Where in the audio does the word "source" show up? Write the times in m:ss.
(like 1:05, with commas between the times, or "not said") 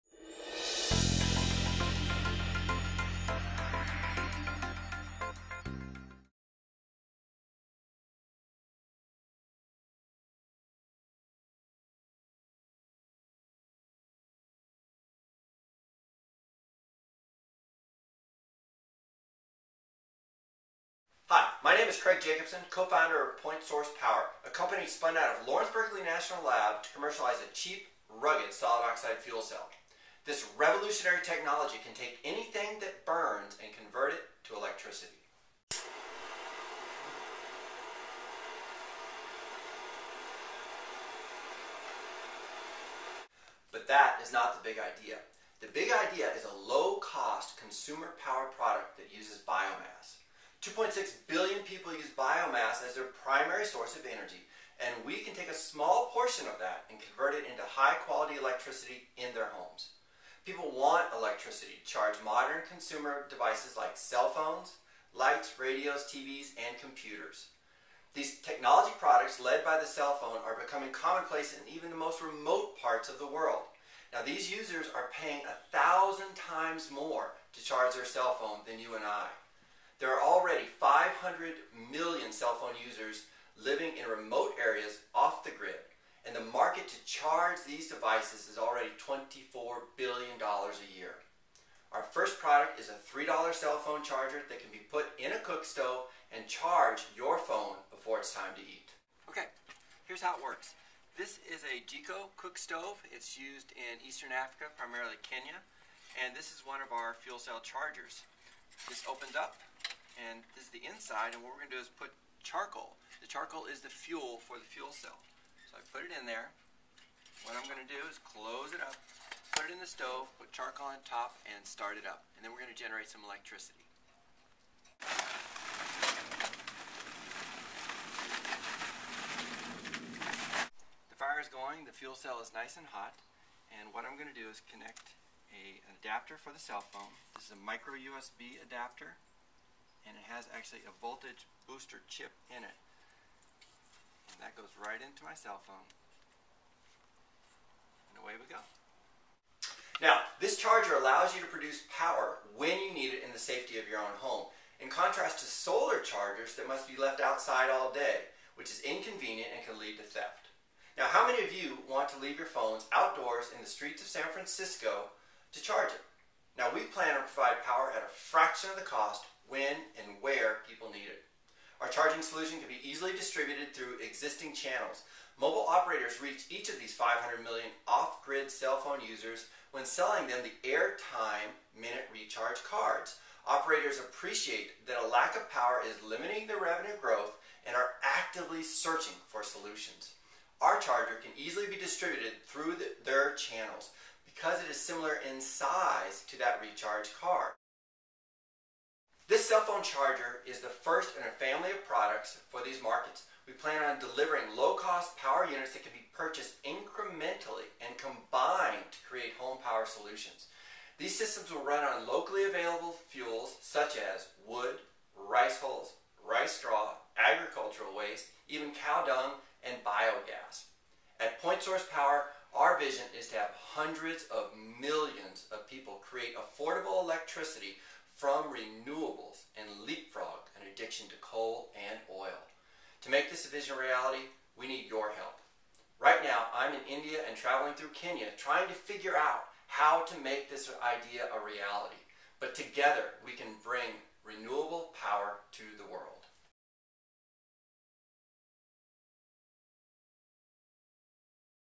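0:23, 0:53, 3:41.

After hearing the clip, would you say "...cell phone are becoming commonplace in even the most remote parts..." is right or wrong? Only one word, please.
right.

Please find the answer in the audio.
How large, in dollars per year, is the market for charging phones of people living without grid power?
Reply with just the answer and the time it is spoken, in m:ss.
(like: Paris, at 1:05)
$24 billion, at 1:28.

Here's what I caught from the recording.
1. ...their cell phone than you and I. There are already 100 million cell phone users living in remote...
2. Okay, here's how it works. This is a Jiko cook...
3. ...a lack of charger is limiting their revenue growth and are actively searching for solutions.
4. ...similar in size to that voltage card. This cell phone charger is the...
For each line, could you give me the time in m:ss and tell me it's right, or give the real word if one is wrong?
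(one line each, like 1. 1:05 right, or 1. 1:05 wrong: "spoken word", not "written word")
1. 1:17 wrong: "500", not "100"
2. 1:39 right
3. 3:05 wrong: "power", not "charger"
4. 3:14 wrong: "recharge", not "voltage".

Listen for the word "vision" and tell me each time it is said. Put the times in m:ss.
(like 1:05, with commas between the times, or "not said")
3:42, 3:53.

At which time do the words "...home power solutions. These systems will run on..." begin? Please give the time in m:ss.
3:29.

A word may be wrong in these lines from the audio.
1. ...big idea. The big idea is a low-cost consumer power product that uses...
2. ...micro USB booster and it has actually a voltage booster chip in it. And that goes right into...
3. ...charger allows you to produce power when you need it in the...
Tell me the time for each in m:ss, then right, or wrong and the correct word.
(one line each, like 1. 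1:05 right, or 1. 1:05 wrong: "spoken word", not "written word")
1. 0:44 right
2. 2:17 wrong: "adapter", not "booster"
3. 2:30 right.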